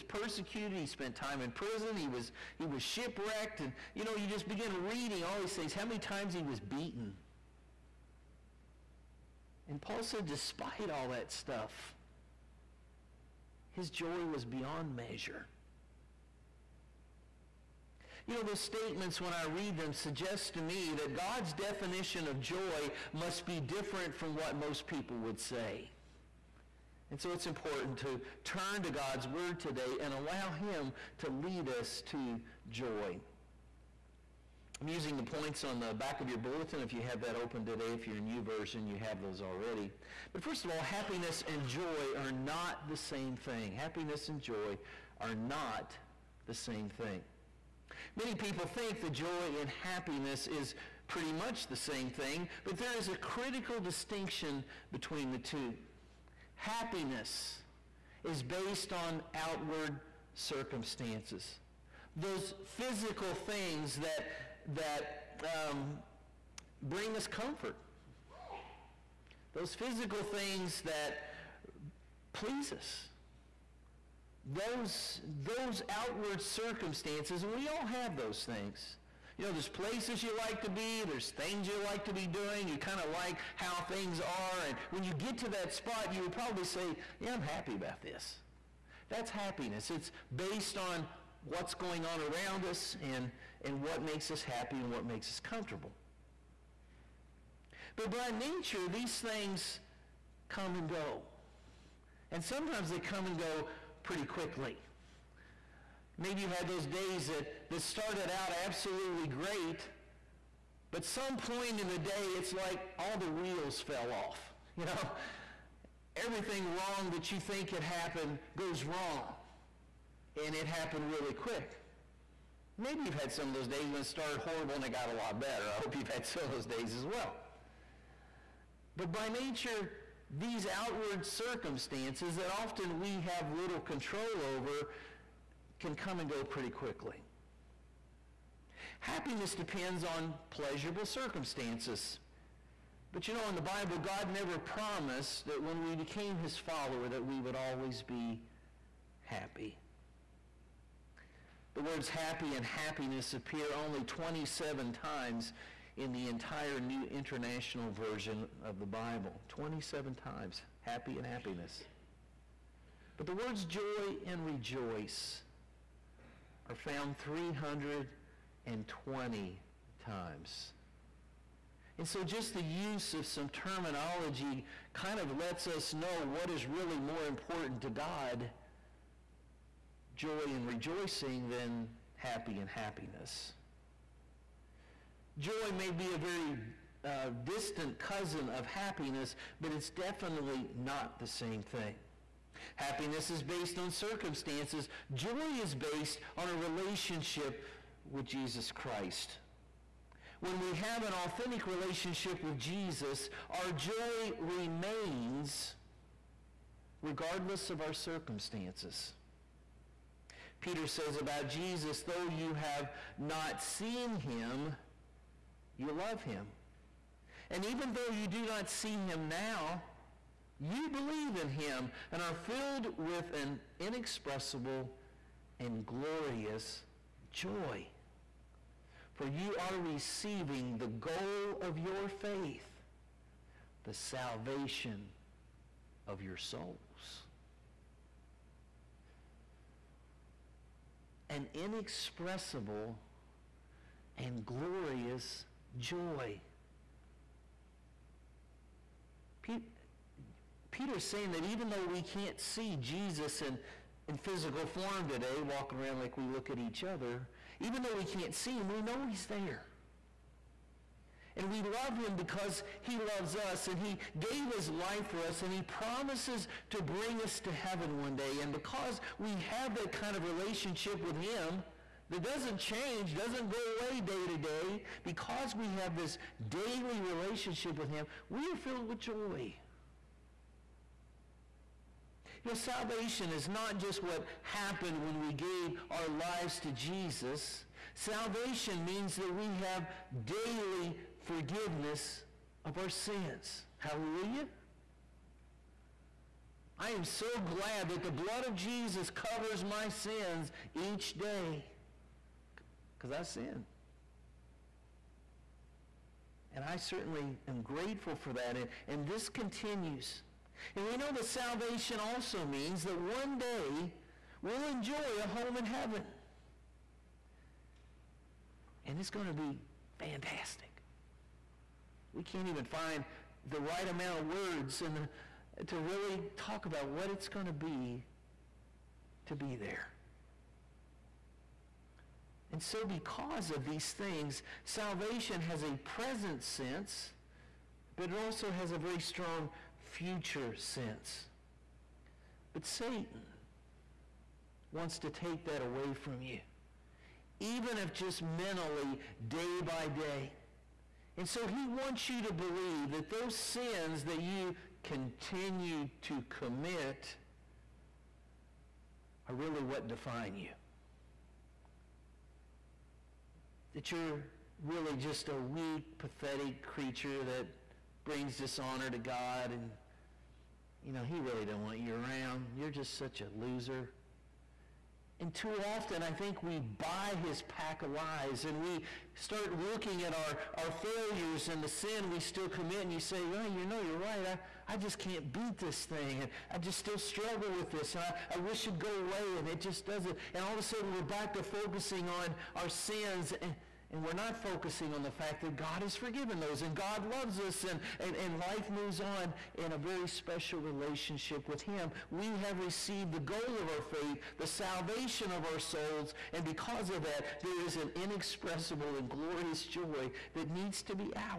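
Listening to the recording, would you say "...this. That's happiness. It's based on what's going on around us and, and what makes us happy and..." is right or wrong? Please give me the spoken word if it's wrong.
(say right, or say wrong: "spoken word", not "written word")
right.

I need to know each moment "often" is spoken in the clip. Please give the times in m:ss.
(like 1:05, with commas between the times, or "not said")
2:12, 6:15.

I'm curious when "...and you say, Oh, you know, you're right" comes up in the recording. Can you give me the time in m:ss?
6:22.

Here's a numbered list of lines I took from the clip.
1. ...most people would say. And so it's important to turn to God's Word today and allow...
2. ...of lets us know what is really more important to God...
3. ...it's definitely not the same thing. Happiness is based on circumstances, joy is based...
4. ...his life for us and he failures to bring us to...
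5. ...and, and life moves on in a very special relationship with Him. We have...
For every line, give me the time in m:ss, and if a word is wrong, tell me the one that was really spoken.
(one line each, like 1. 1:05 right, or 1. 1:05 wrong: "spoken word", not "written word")
1. 0:24 right
2. 2:55 right
3. 3:09 right
4. 4:24 wrong: "promises", not "failures"
5. 6:37 right.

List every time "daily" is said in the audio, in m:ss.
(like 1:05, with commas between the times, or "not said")
4:36, 4:50.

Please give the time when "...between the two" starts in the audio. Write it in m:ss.
0:54.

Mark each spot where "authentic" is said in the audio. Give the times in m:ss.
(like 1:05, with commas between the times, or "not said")
3:21.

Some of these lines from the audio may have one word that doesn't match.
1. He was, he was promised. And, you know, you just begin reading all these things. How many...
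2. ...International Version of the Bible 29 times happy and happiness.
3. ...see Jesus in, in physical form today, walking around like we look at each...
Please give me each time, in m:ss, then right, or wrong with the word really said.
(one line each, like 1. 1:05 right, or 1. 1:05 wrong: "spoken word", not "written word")
1. 0:01 wrong: "shipwrecked", not "promised"
2. 2:37 wrong: "27", not "29"
3. 4:12 right.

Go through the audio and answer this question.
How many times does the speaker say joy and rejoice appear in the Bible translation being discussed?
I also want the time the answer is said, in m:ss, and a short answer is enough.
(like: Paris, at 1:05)
320, at 2:47.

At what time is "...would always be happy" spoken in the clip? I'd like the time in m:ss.
2:27.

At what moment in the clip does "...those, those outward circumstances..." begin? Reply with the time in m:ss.
1:14.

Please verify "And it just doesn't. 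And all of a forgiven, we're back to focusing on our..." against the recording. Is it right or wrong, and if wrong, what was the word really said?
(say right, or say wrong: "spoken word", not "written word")
wrong: "sudden", not "forgiven".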